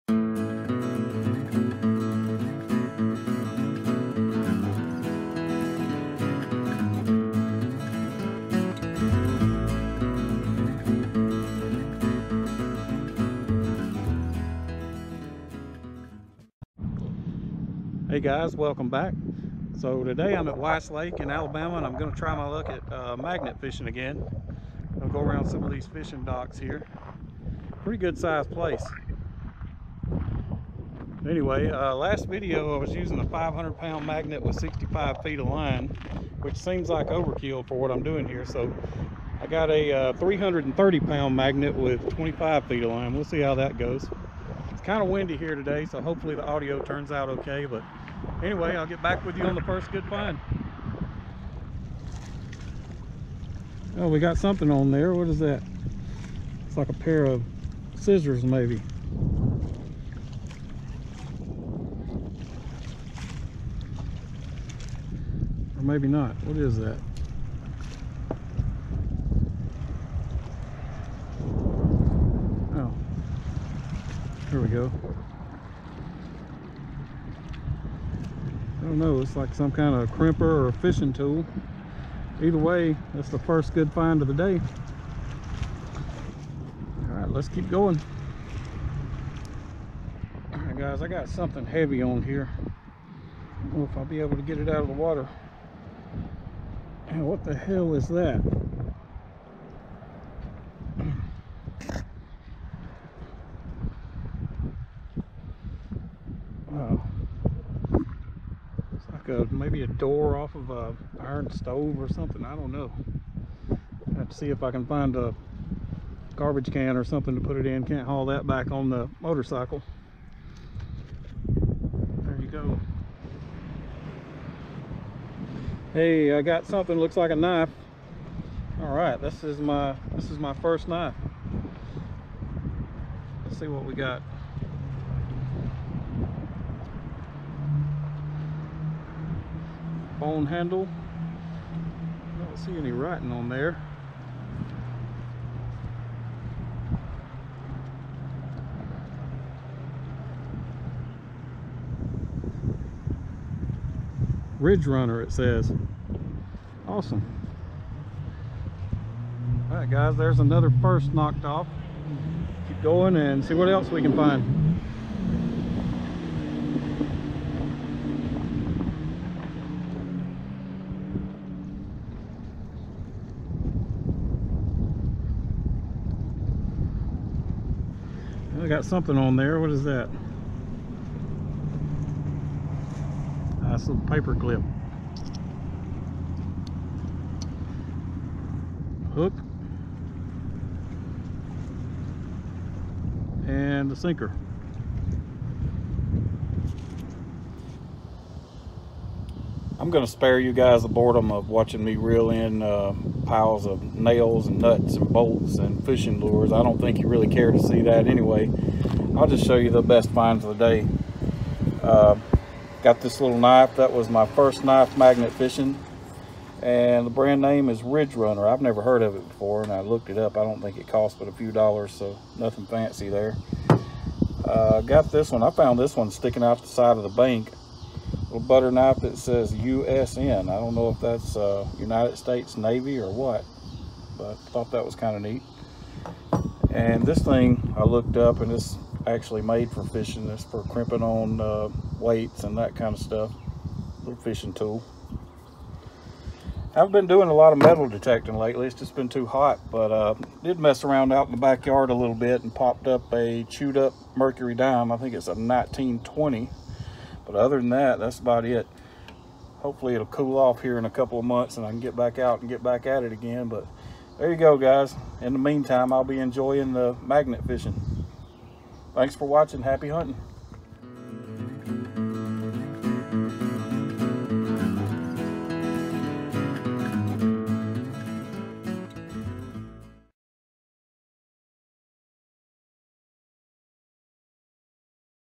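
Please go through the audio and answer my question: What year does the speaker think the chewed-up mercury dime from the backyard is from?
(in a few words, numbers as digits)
1920.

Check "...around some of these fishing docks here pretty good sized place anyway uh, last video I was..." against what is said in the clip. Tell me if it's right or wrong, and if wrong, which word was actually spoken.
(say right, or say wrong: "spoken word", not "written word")
right.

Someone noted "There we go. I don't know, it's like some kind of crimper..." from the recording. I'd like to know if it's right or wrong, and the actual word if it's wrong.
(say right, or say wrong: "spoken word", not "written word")
right.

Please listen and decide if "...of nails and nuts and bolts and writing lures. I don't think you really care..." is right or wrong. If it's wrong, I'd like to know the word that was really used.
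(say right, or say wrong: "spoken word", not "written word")
wrong: "fishing", not "writing".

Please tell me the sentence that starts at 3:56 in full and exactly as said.
And this thing I looked up and it's actually made for fishing.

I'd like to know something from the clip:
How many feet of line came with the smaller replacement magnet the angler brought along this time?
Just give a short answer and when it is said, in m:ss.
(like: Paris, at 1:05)
25 feet, at 0:42.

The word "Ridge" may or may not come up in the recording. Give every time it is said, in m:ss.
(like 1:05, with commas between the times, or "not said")
2:34, 3:37.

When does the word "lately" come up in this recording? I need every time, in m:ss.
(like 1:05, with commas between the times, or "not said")
4:08.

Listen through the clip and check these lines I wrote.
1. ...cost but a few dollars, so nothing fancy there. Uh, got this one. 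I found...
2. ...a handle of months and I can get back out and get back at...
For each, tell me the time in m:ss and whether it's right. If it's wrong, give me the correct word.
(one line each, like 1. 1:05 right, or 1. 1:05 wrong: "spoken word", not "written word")
1. 3:40 right
2. 4:20 wrong: "couple", not "handle".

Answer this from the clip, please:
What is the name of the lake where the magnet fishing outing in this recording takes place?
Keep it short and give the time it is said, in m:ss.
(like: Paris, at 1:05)
Weiss Lake, at 0:20.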